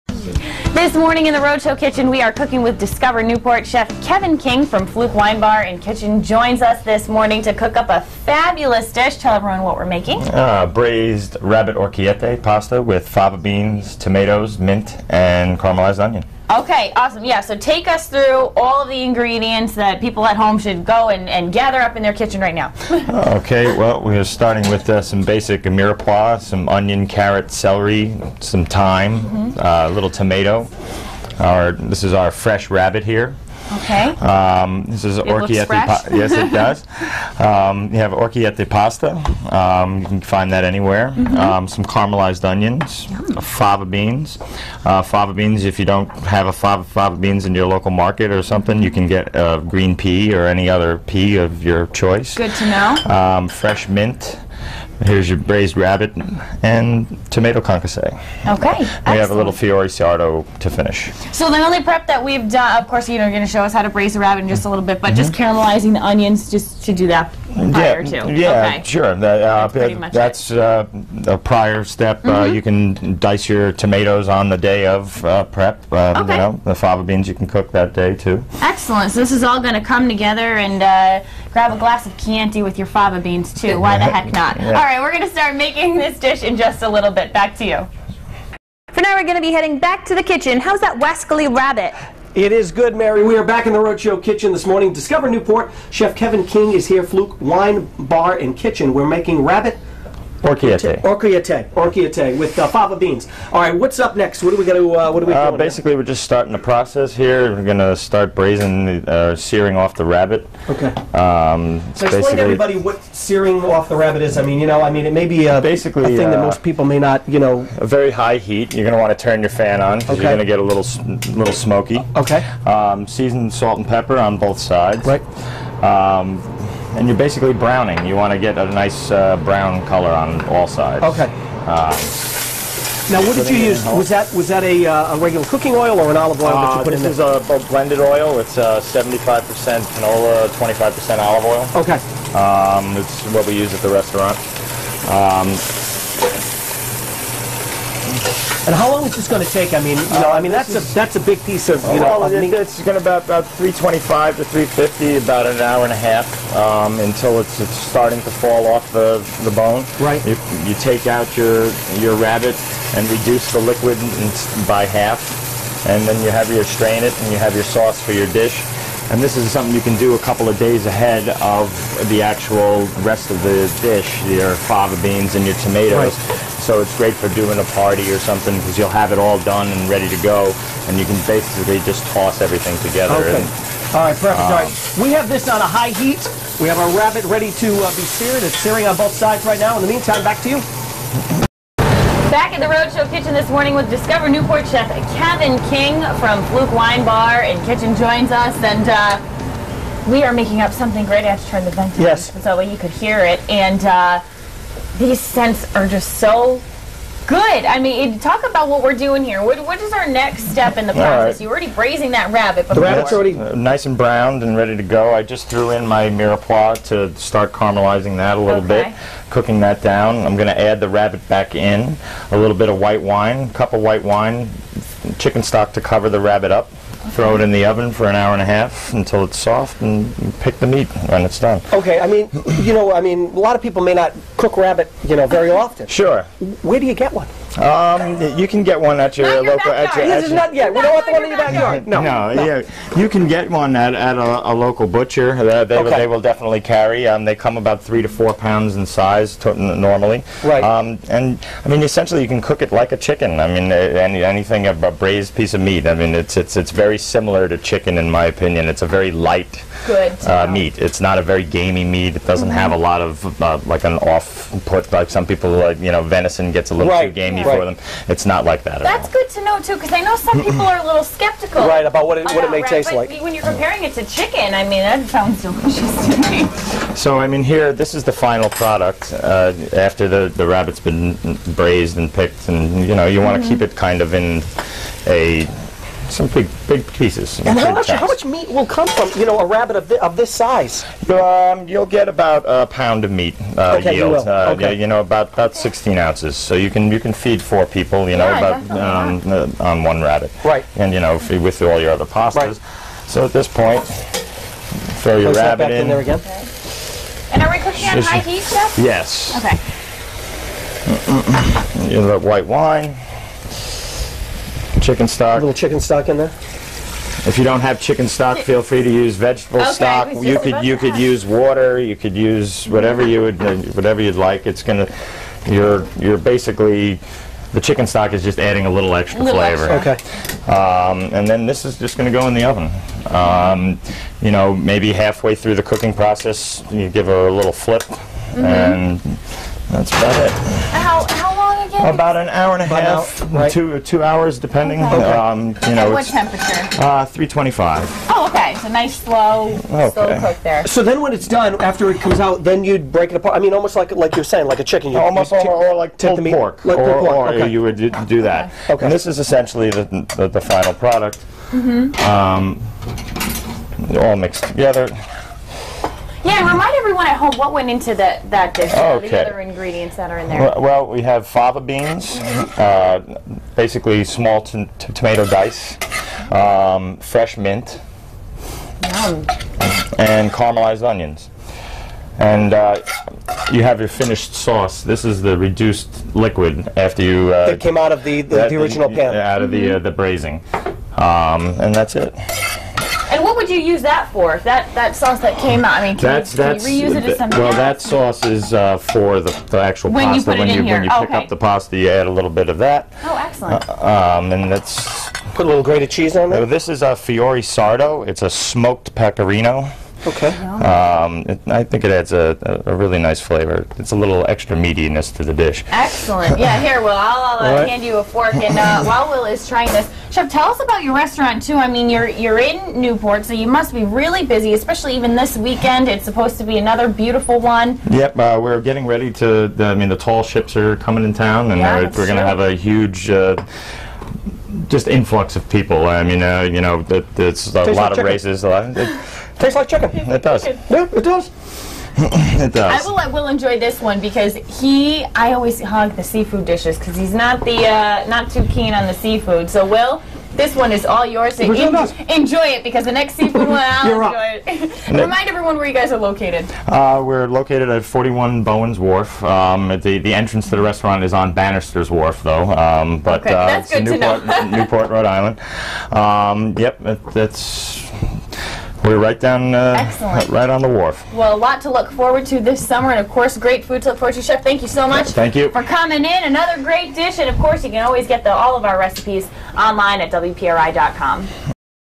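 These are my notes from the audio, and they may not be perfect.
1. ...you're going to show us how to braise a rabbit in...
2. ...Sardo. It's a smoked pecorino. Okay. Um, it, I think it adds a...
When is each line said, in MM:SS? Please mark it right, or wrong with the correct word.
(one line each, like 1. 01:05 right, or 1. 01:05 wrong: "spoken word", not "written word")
1. 01:03 right
2. 06:47 right.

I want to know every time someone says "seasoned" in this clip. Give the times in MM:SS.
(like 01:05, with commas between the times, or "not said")
02:03.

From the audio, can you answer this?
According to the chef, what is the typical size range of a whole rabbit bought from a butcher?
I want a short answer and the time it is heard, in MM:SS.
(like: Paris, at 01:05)
3 to 4 pounds, at 04:07.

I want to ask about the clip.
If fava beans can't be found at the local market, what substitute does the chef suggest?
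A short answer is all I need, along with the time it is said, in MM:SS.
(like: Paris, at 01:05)
green pea, at 00:49.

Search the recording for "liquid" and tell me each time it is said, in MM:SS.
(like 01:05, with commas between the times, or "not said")
02:43, 06:26.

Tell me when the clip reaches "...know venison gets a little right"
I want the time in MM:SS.
04:25.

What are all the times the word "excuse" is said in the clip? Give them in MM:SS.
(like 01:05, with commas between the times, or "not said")
not said.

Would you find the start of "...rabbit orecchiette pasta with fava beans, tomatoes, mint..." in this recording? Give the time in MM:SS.
00:11.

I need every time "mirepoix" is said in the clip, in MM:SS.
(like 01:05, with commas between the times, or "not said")
00:25, 03:36.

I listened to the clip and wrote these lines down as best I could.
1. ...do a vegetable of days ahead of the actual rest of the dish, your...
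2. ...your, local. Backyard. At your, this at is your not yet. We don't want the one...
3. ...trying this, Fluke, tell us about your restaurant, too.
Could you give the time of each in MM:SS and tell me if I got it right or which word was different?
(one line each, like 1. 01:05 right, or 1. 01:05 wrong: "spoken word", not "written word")
1. 02:49 wrong: "couple", not "vegetable"
2. 03:59 right
3. 06:59 wrong: "Chef", not "Fluke".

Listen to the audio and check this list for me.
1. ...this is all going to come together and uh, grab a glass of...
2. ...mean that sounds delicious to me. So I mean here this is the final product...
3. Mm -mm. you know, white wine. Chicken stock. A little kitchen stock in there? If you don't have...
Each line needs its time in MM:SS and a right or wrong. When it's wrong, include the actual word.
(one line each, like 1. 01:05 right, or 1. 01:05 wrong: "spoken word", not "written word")
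1. 01:19 right
2. 04:34 right
3. 05:10 wrong: "chicken", not "kitchen".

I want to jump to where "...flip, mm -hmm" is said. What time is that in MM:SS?
05:37.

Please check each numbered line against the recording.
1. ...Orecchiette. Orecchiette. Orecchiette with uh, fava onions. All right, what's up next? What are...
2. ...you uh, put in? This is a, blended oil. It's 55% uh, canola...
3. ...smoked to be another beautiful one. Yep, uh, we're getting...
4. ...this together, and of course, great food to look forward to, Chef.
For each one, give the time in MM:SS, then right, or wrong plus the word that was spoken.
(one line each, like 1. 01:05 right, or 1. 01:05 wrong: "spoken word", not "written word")
1. 01:40 wrong: "beans", not "onions"
2. 02:16 wrong: "75", not "55"
3. 07:06 wrong: "supposed", not "smoked"
4. 07:52 wrong: "summer", not "together".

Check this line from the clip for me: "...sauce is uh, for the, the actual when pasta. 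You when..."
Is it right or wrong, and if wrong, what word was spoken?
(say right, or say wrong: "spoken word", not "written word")
right.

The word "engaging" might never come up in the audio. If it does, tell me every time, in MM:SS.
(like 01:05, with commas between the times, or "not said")
not said.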